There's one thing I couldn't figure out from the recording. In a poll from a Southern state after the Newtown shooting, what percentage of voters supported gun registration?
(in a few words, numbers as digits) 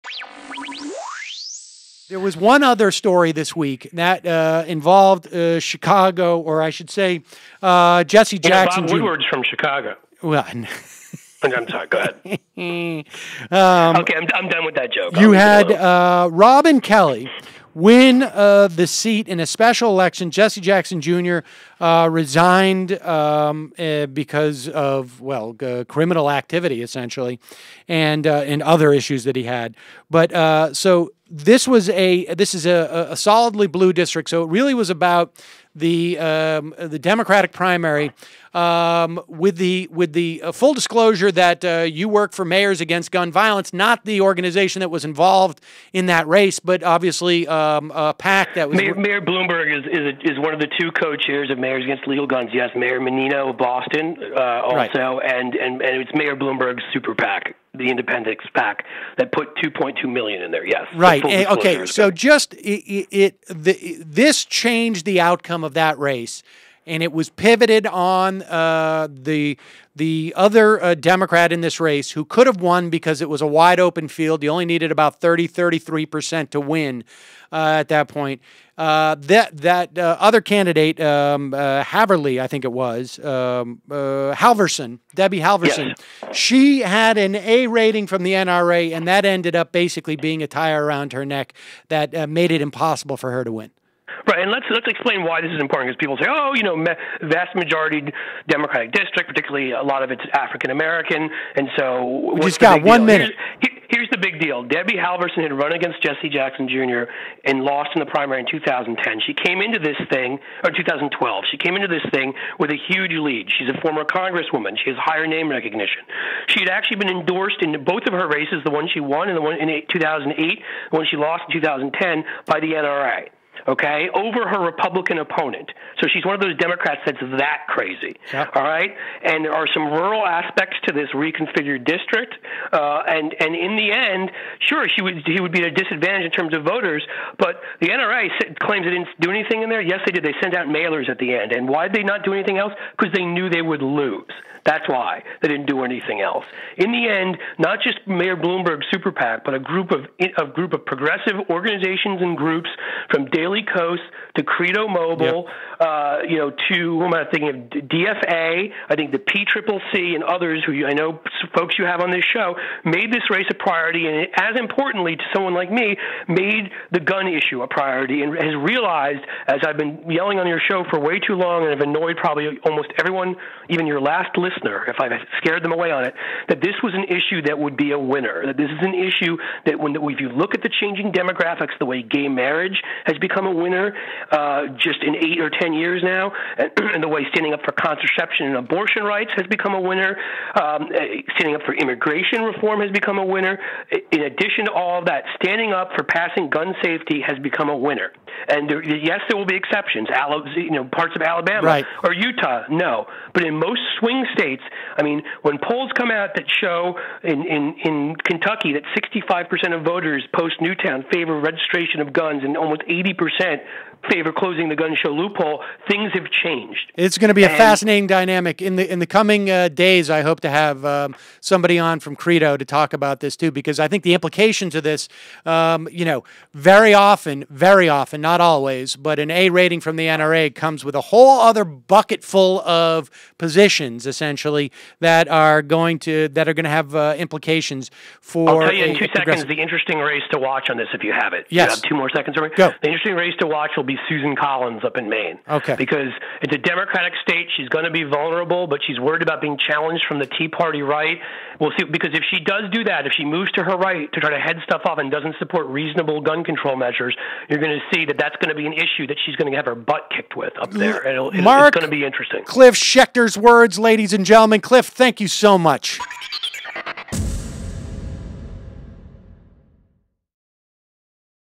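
65%.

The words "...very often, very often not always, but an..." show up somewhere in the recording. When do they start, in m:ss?
3:46.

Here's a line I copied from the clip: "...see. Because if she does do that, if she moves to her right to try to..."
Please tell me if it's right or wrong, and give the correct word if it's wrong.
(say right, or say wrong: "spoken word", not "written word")
right.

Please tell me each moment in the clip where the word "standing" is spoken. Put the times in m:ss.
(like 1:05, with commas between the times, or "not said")
3:07, 3:11, 3:15.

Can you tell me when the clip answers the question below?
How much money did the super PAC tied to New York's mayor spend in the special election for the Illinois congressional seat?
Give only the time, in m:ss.
0:59.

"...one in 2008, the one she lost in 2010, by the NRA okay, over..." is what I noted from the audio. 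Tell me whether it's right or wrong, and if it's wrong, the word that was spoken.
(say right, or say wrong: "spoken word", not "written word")
right.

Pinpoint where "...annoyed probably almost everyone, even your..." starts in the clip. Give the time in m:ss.
2:51.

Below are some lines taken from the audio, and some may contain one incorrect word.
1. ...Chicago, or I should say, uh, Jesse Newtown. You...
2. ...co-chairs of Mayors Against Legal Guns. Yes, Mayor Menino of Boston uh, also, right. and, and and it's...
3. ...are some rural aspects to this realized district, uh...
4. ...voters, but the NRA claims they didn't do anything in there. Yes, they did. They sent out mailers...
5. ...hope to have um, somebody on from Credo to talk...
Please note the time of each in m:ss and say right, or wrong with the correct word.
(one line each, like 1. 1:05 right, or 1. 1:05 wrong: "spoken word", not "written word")
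1. 0:05 wrong: "Jackson", not "Newtown"
2. 0:50 right
3. 2:09 wrong: "reconfigured", not "realized"
4. 2:16 right
5. 3:40 right.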